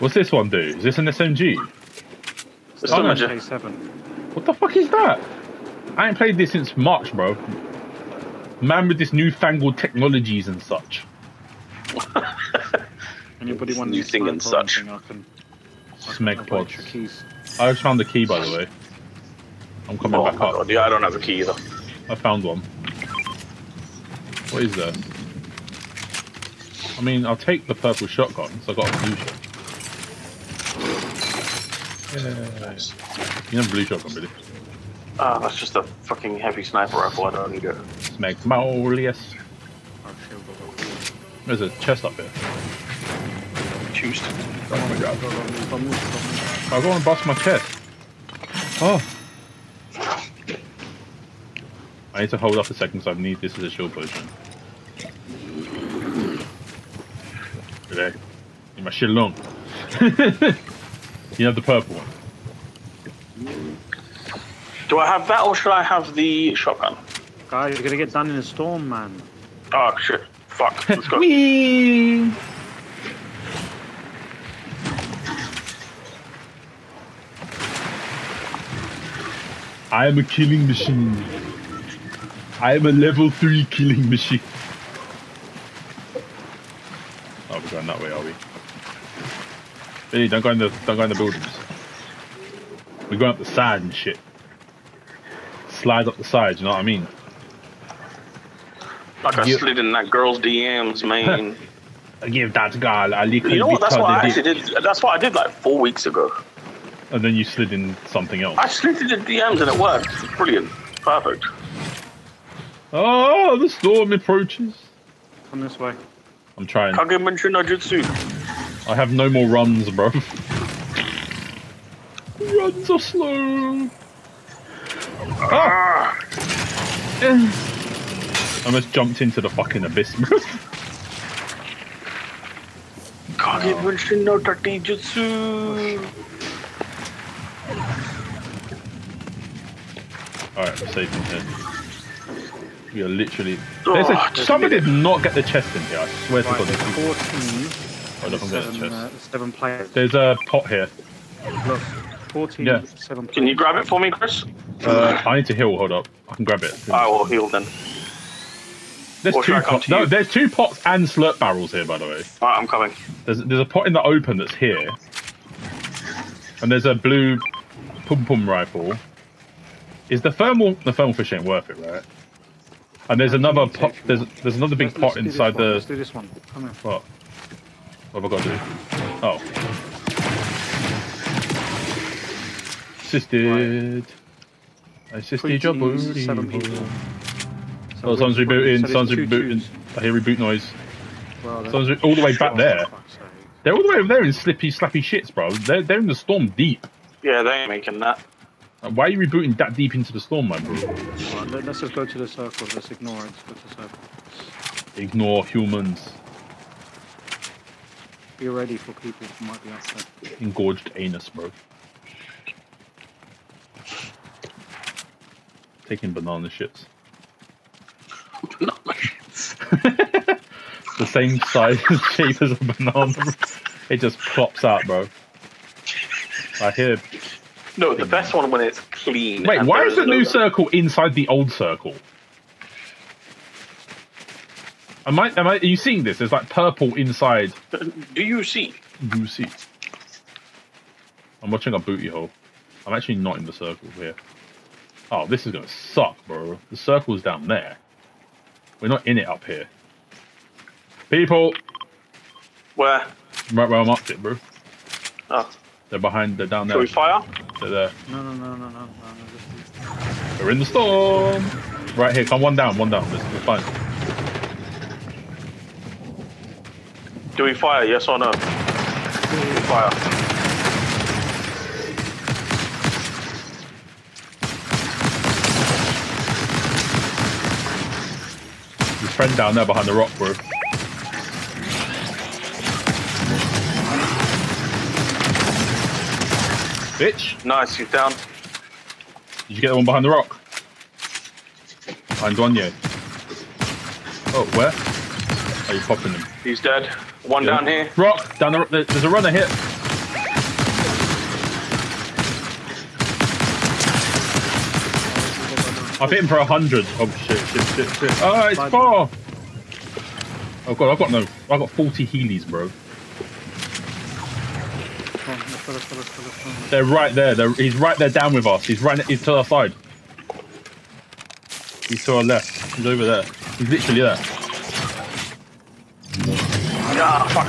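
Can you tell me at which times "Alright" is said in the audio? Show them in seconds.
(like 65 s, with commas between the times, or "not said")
140 s, 162 s.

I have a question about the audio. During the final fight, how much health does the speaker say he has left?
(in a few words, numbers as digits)
40.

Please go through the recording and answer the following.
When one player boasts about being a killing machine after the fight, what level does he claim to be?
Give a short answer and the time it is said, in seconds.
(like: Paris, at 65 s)
3, at 82 s.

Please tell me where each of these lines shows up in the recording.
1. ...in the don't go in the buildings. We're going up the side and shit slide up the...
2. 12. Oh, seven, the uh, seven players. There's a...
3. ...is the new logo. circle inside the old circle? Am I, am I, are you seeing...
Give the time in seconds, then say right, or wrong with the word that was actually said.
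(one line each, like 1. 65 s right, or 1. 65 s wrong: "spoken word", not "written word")
1. 90 s right
2. 147 s wrong: "14", not "12"
3. 229 s right.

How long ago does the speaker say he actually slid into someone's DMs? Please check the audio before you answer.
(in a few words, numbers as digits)
four weeks ago.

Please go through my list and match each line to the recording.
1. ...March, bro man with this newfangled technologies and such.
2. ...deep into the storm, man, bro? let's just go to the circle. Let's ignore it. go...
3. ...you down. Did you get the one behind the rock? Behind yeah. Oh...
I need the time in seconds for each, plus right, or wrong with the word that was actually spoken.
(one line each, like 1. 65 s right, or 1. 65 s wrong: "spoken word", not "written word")
1. 6 s right
2. 199 s right
3. 287 s right.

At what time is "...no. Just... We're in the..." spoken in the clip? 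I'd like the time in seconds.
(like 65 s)
258 s.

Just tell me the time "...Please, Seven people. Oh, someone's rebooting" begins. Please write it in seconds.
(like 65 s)
185 s.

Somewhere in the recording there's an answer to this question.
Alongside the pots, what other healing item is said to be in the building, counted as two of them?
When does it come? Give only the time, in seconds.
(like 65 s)
161 s.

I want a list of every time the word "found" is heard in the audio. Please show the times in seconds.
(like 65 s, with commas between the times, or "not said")
17 s, 22 s.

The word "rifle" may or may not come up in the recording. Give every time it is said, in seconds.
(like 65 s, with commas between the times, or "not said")
36 s, 168 s.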